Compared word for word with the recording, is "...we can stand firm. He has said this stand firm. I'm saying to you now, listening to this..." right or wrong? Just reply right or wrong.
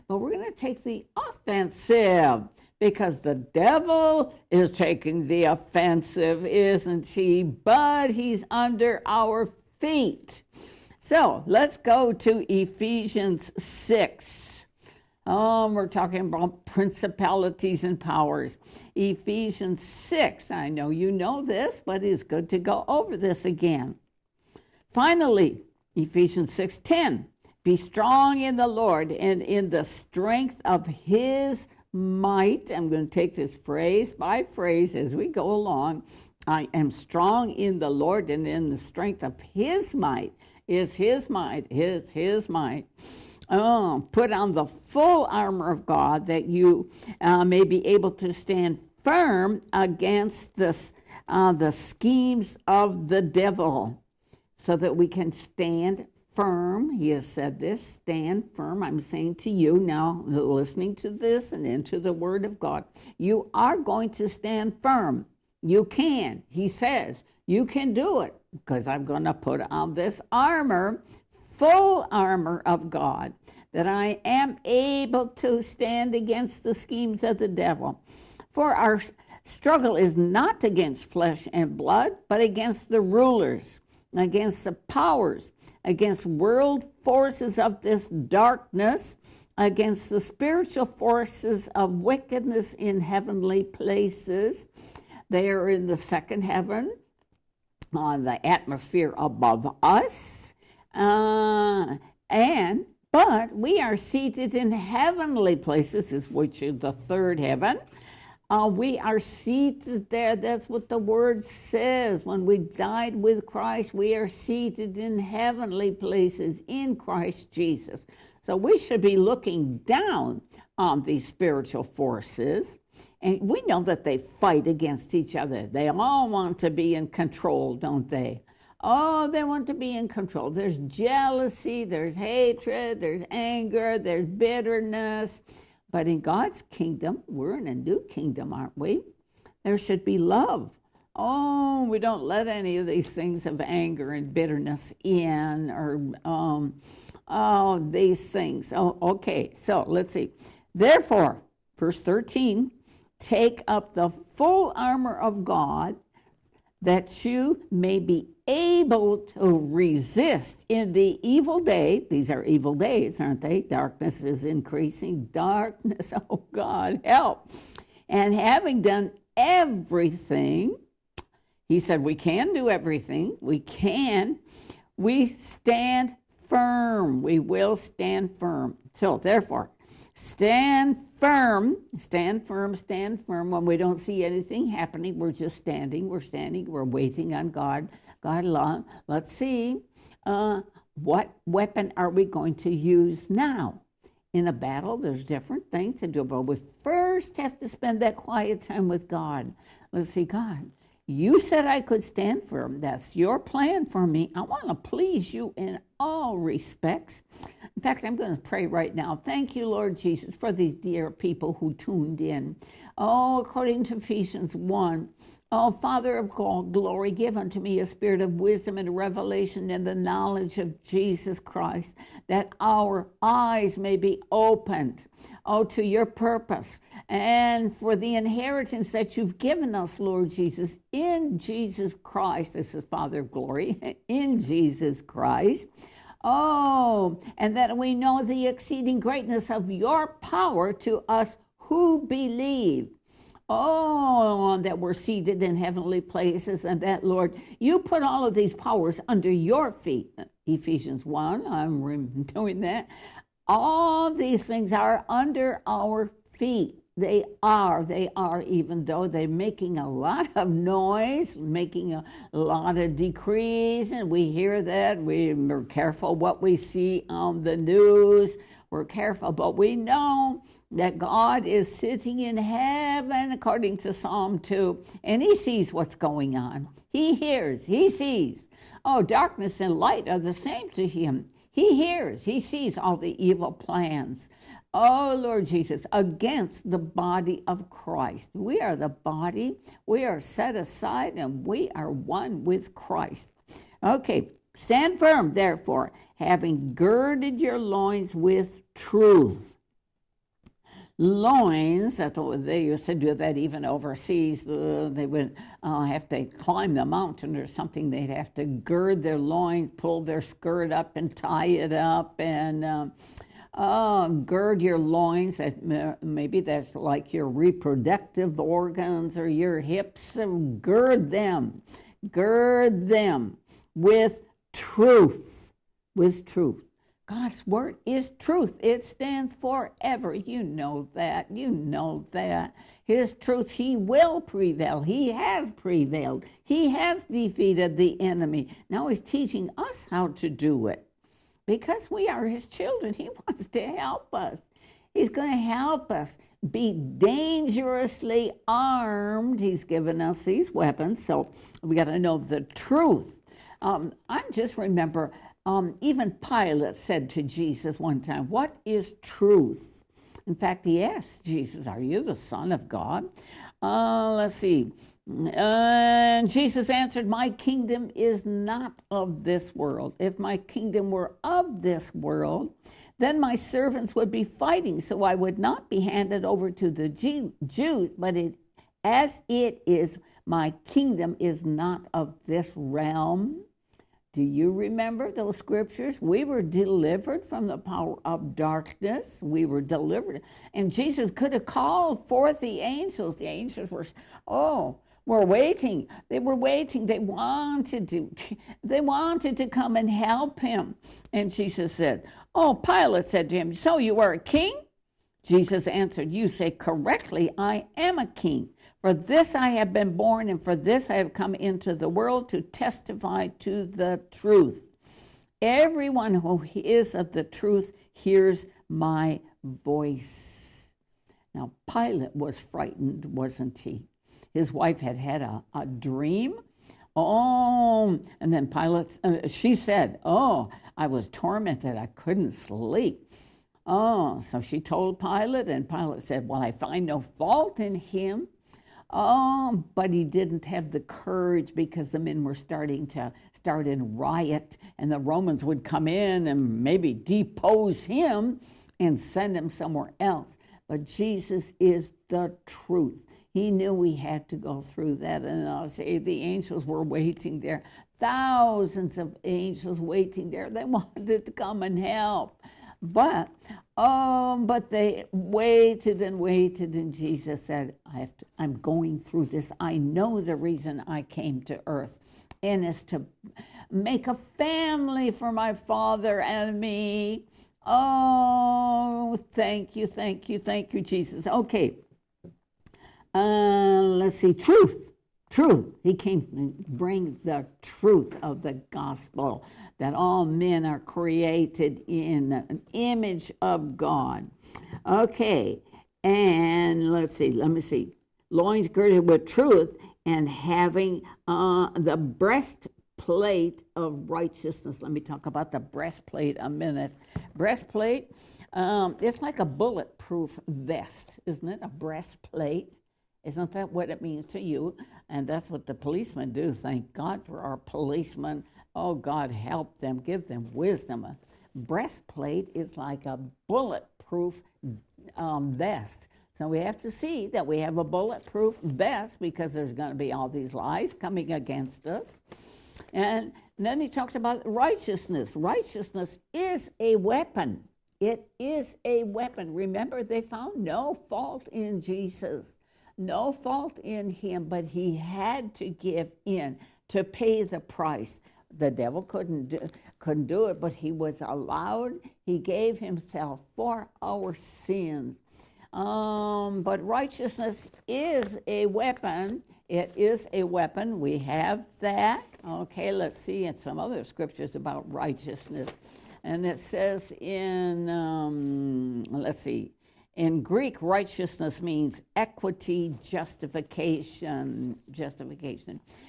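right.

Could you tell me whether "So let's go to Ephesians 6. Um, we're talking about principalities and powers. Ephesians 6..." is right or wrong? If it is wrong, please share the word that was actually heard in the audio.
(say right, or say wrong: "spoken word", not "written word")
right.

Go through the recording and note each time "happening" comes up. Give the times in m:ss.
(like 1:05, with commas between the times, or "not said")
3:04.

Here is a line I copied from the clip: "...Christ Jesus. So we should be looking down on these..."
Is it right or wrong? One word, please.
right.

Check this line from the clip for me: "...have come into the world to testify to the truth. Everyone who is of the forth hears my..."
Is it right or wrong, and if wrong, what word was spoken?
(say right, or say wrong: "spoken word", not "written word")
wrong: "truth", not "forth".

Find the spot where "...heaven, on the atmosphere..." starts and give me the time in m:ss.
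1:36.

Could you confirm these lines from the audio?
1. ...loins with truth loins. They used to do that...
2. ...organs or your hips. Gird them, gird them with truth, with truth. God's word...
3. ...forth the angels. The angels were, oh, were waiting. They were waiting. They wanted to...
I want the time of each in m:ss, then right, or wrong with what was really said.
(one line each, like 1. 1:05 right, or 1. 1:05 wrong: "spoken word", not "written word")
1. 4:57 right
2. 5:18 right
3. 6:32 right.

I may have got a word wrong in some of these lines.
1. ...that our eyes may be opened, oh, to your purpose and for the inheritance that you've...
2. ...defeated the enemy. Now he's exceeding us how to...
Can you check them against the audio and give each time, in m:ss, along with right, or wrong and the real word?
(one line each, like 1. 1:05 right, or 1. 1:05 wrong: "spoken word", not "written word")
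1. 3:42 right
2. 5:37 wrong: "teaching", not "exceeding".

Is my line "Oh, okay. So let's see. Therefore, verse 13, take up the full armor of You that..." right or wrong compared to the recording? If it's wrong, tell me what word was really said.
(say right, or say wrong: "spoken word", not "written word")
wrong: "God", not "You".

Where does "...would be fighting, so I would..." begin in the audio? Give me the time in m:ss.
6:13.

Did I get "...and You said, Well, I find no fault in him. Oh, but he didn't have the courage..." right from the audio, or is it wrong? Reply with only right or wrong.
wrong.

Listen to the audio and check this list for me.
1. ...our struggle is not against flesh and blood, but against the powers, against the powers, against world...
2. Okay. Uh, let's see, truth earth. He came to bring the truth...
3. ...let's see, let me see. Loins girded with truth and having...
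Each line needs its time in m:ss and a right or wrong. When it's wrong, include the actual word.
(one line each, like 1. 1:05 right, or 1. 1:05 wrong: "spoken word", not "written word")
1. 1:18 wrong: "rulers", not "powers"
2. 8:01 wrong: "truth", not "earth"
3. 8:16 right.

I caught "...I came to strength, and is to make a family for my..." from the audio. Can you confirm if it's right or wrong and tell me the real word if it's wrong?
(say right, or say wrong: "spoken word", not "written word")
wrong: "earth", not "strength".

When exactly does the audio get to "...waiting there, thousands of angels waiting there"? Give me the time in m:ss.
7:36.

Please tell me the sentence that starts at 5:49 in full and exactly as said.
He's given us these weapons, so we got to know the truth.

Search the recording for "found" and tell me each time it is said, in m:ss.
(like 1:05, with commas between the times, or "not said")
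9:00.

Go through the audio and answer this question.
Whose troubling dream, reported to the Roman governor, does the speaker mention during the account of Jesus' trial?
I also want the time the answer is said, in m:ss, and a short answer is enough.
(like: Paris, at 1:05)
His wife's, at 7:04.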